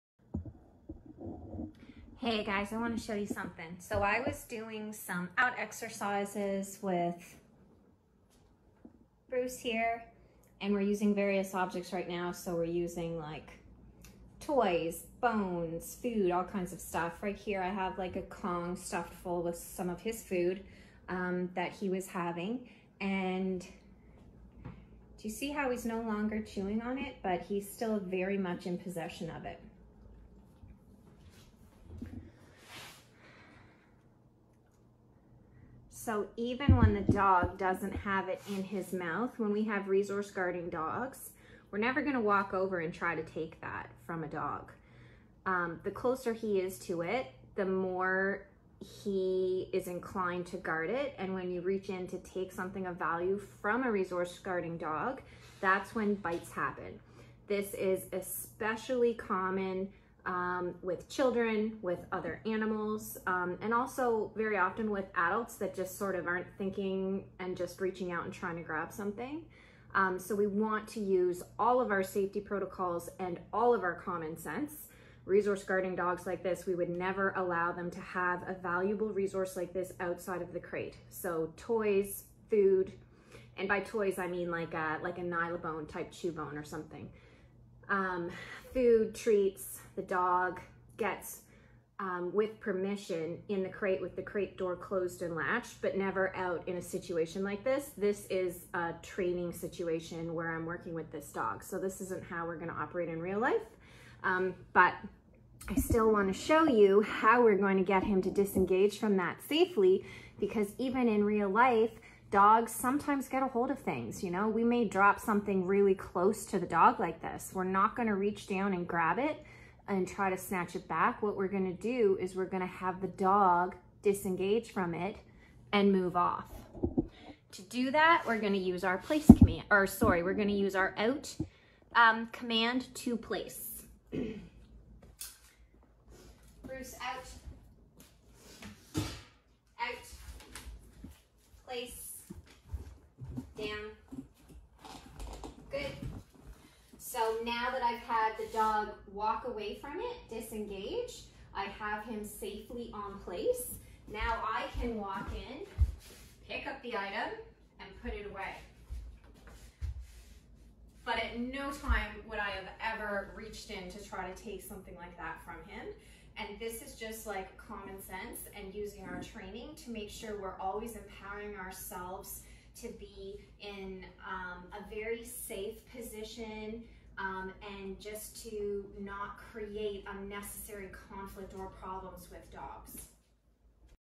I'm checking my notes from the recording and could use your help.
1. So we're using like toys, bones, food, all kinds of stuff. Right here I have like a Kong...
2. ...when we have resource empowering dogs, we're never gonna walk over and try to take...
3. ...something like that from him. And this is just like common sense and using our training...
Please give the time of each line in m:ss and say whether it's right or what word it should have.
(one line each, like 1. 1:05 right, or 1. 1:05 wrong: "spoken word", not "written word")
1. 0:12 right
2. 0:39 wrong: "guarding", not "empowering"
3. 2:44 right.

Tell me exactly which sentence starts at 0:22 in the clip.
And do you see how he's no longer chewing on it, but he's still very much in possession of it.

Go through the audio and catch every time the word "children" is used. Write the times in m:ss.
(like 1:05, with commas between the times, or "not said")
1:01.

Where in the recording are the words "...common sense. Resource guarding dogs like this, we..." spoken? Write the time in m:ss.
1:13.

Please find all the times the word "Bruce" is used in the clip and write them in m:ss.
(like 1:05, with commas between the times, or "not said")
0:09, 2:16.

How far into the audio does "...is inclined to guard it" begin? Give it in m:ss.
0:49.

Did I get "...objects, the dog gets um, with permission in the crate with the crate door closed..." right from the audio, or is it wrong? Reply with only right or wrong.
wrong.